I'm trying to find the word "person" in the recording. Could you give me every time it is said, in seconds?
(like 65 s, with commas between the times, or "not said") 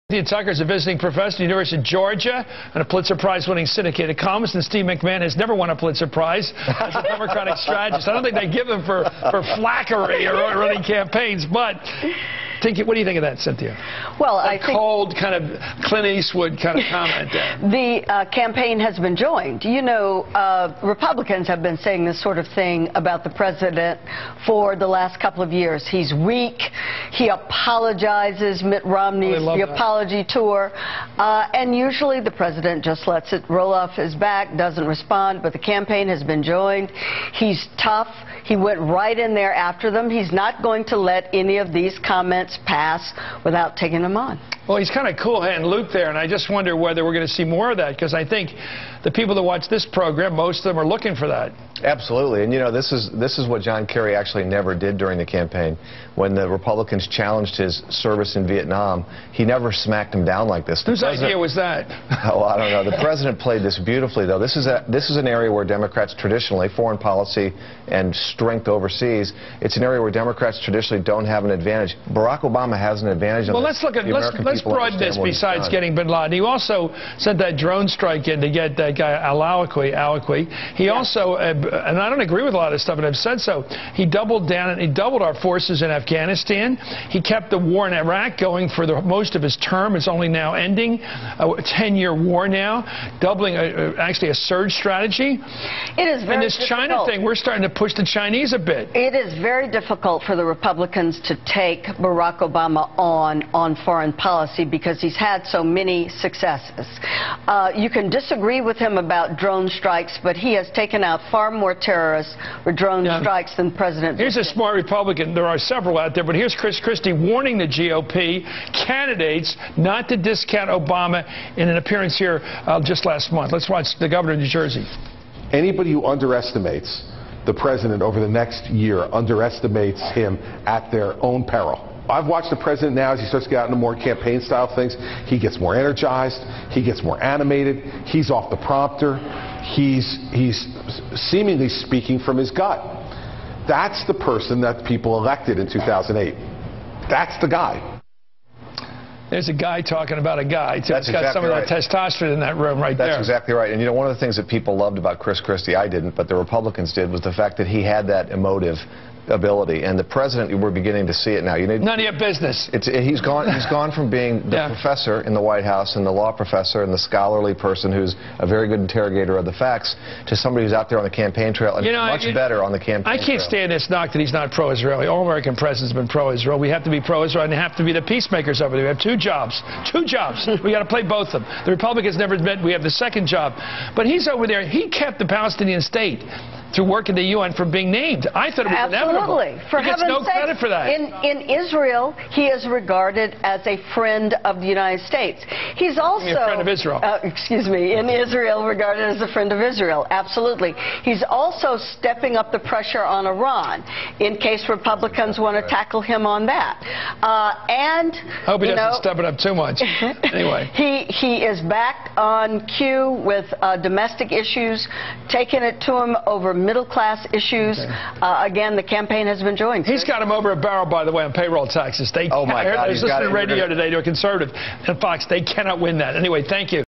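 144 s, 167 s.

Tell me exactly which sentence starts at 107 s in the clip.
Uh, you can disagree with him about drone strikes, but he has taken out far more more terrorists or drone yeah.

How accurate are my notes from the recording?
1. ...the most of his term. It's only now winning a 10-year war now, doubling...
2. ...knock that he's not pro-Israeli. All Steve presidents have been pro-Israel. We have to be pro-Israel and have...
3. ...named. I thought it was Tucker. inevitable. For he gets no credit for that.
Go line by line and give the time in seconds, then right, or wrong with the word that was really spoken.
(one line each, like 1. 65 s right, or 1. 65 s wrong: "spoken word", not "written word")
1. 88 s wrong: "ending", not "winning"
2. 173 s wrong: "American", not "Steve"
3. 187 s wrong: "Absolutely", not "Tucker".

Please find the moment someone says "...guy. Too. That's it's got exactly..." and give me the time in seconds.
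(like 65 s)
150 s.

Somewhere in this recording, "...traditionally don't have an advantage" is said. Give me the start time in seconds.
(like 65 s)
70 s.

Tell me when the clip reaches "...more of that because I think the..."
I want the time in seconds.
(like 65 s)
47 s.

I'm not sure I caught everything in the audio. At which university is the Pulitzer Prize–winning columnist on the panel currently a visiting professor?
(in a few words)
University of Georgia.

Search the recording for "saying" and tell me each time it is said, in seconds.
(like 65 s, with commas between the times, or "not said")
21 s.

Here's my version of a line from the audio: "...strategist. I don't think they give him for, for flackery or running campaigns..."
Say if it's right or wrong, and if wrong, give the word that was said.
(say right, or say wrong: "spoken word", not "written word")
right.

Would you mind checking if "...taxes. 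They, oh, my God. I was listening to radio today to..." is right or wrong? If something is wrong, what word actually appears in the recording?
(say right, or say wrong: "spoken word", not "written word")
right.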